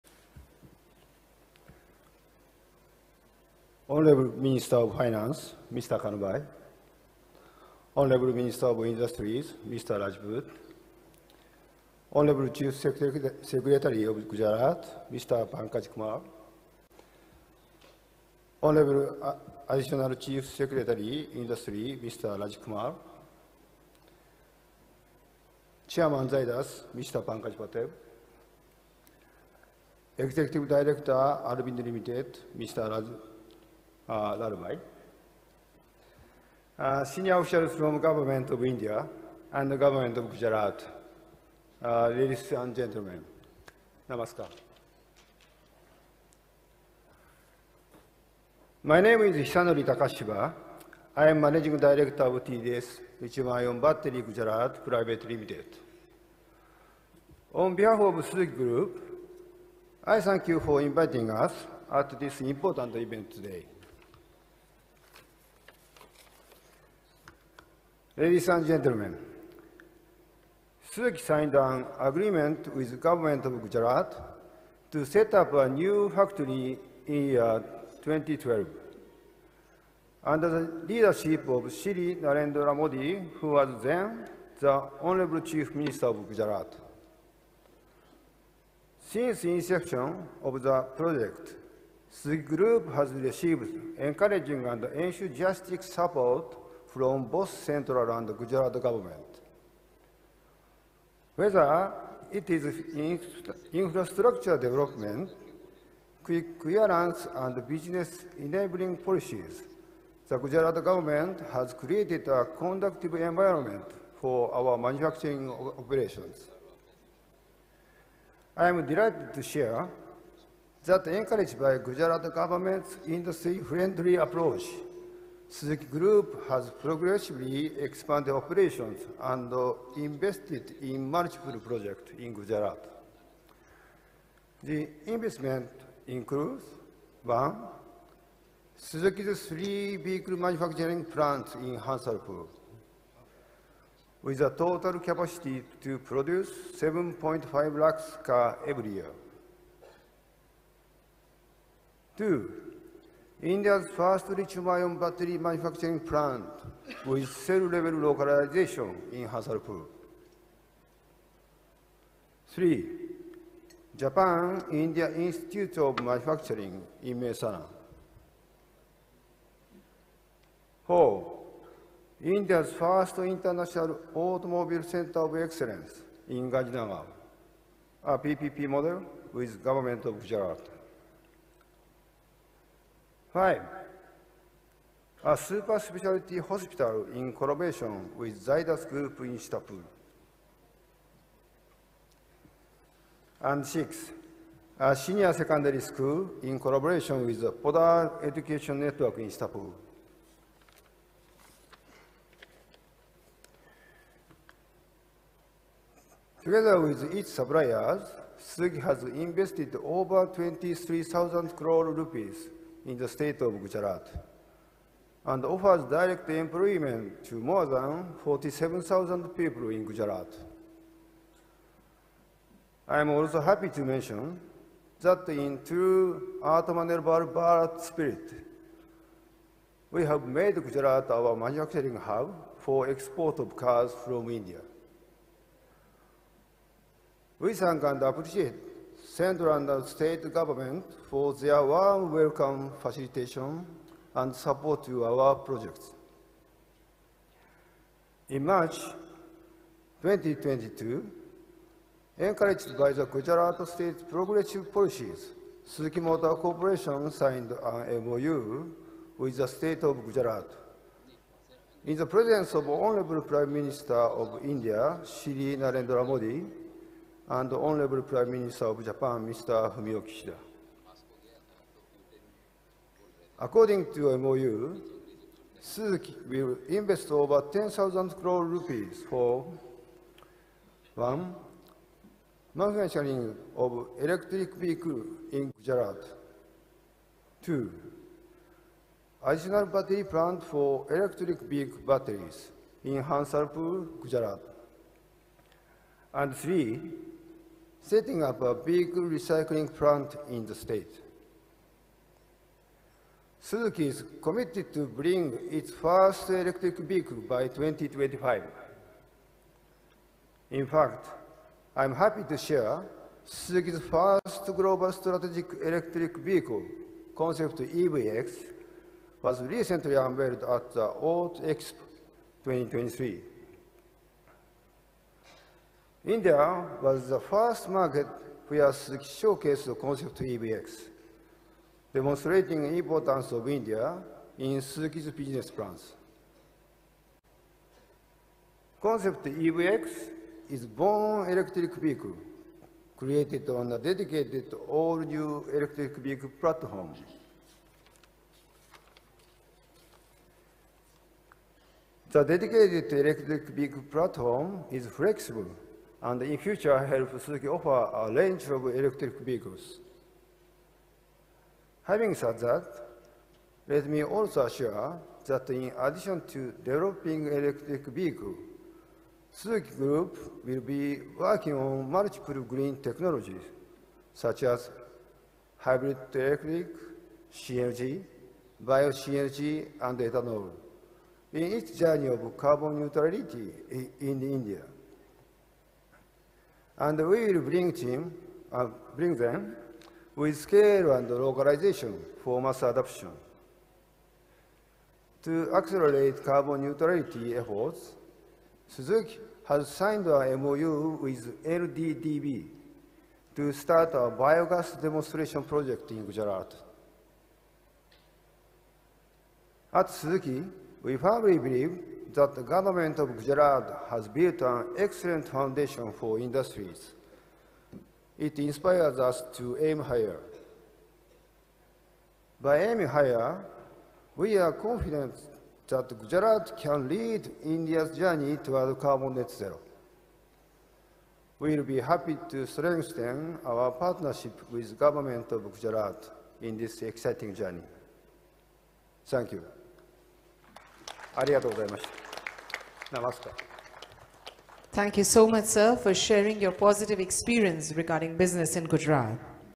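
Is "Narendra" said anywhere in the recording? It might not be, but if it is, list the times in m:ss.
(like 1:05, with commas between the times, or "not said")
1:22, 4:25.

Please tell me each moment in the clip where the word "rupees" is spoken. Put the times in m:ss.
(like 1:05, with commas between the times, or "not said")
3:31, 4:38.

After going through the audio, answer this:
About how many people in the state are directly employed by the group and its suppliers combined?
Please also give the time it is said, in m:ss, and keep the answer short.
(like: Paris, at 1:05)
47,000, at 3:38.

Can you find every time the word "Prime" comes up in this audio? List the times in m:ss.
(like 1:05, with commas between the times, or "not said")
4:23, 4:28.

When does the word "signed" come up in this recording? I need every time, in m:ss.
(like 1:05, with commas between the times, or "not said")
1:11, 4:17, 6:39.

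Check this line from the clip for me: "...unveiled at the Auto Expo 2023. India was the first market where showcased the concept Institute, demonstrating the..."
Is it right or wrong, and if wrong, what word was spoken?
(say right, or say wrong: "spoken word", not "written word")
wrong: "EVX", not "Institute".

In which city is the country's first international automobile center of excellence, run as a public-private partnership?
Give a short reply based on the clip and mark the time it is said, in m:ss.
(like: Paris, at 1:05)
Gandhinagar, at 2:56.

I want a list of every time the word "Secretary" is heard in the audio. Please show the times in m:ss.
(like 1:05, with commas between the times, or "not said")
0:12, 0:20.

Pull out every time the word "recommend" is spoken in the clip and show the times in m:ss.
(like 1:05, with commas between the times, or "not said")
not said.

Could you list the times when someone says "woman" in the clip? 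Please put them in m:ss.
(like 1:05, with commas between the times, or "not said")
not said.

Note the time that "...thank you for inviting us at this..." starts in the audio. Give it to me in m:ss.
1:00.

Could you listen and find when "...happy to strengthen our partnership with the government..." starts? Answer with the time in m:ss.
7:11.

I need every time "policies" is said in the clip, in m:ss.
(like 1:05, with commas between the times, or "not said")
1:48, 4:14.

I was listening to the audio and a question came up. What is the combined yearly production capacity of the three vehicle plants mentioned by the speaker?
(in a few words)
7.5 lakh cars.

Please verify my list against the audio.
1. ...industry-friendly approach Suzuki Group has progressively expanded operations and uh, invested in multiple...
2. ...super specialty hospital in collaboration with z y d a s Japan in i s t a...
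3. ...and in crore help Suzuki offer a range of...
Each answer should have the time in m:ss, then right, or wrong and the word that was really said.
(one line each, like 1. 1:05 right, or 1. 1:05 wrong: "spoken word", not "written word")
1. 2:03 right
2. 3:05 wrong: "Group", not "Japan"
3. 5:56 wrong: "future", not "crore".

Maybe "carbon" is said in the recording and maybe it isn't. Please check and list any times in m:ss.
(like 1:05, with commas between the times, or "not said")
6:22, 6:36, 7:08.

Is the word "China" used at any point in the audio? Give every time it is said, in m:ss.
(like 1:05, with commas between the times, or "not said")
not said.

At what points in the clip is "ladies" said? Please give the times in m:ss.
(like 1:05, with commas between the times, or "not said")
0:42, 1:08.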